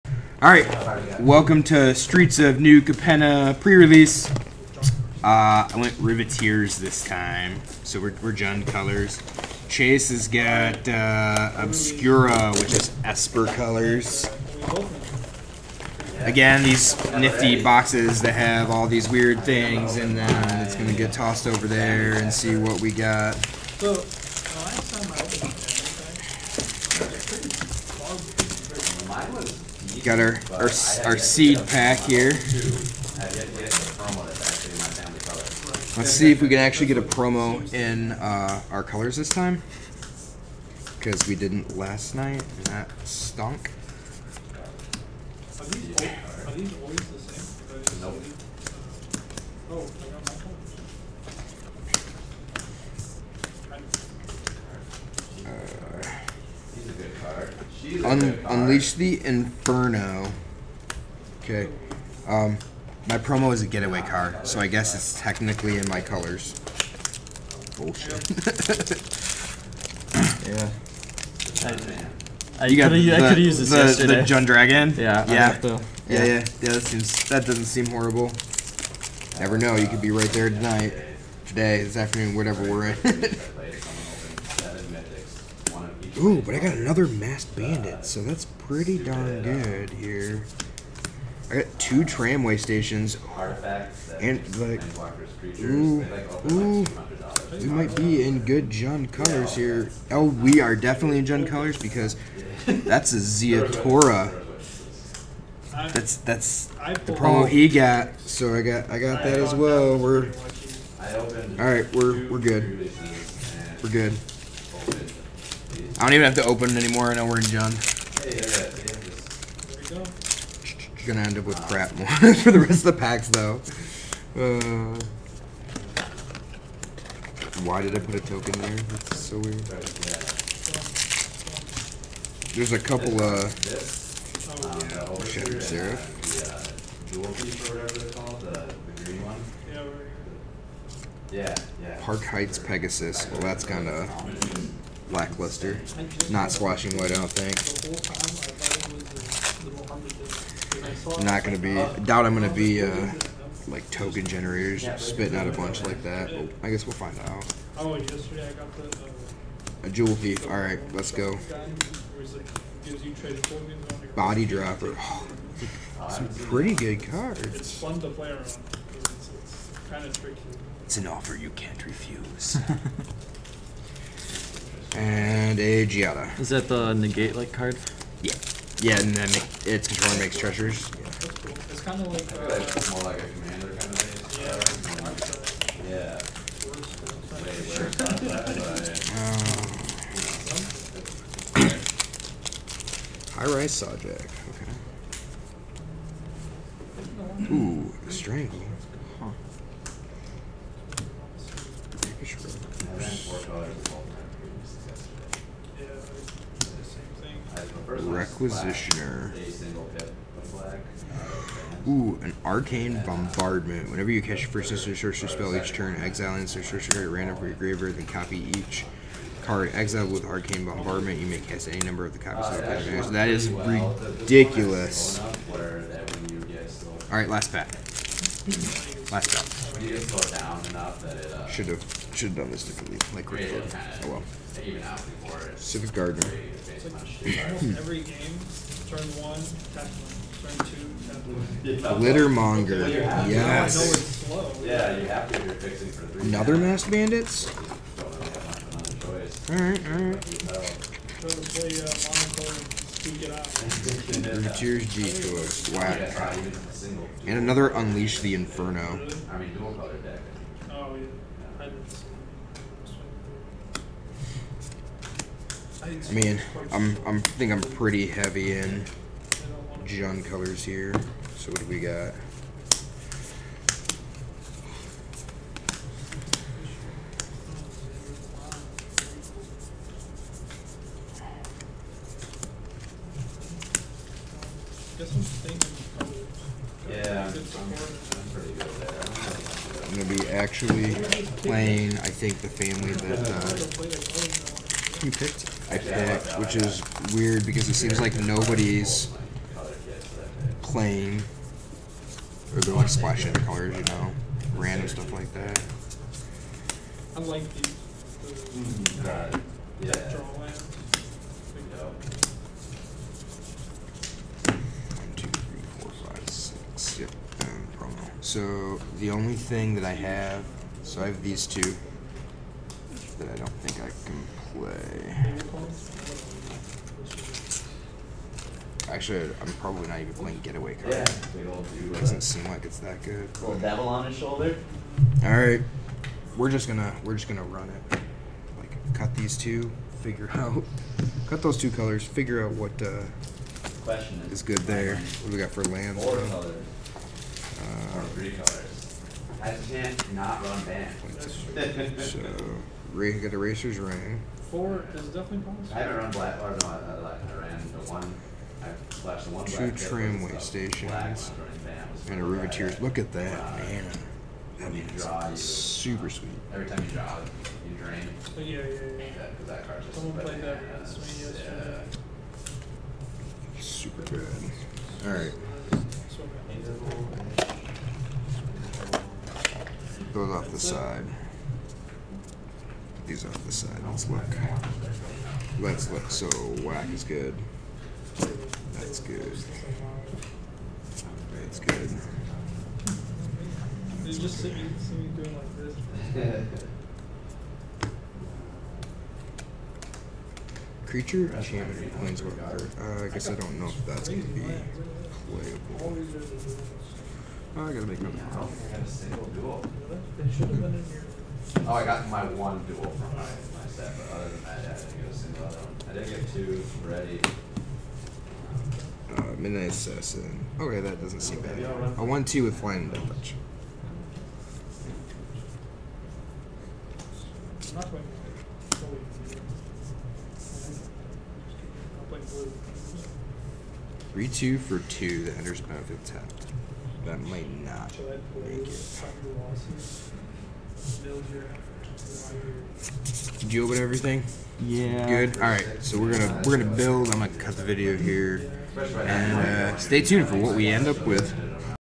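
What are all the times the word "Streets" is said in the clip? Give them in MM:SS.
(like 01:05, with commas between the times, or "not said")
00:01.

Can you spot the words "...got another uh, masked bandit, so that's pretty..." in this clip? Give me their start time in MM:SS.
01:26.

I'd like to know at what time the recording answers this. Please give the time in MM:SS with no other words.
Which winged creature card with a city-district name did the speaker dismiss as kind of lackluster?
02:22.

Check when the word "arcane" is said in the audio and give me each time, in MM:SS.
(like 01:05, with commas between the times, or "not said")
03:32, 03:40.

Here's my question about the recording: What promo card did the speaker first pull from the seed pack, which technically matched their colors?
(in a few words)
Getaway Car.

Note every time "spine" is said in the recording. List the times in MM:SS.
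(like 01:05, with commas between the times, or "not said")
not said.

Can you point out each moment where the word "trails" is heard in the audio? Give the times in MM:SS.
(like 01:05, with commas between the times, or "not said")
not said.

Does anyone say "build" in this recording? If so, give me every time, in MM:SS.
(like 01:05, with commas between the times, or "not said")
07:26.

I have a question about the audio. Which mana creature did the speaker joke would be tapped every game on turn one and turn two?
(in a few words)
Civic Gardener.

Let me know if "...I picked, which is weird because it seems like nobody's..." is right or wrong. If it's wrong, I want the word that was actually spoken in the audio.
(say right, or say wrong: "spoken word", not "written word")
right.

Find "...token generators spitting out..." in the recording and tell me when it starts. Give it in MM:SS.
02:33.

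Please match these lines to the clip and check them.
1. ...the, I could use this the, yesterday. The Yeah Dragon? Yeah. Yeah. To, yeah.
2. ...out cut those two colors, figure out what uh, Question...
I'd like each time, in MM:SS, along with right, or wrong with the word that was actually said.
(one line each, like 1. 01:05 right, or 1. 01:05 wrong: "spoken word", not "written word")
1. 01:12 wrong: "Jund", not "Yeah"
2. 05:40 right.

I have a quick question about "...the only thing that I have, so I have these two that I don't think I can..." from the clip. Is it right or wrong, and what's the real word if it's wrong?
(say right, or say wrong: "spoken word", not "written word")
right.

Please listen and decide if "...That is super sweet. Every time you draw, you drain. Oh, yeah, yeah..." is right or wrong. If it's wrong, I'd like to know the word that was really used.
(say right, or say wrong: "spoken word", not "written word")
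right.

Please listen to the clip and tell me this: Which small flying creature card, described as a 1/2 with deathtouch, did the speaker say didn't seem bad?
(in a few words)
Midnight Assassin.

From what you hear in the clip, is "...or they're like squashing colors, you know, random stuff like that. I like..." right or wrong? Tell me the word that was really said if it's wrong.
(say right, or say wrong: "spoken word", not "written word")
wrong: "splashing", not "squashing".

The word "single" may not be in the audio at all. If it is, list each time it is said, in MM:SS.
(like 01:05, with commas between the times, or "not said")
06:48, 06:55.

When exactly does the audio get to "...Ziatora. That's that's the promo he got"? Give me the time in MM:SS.
01:43.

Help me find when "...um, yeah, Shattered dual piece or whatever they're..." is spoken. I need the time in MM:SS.
02:14.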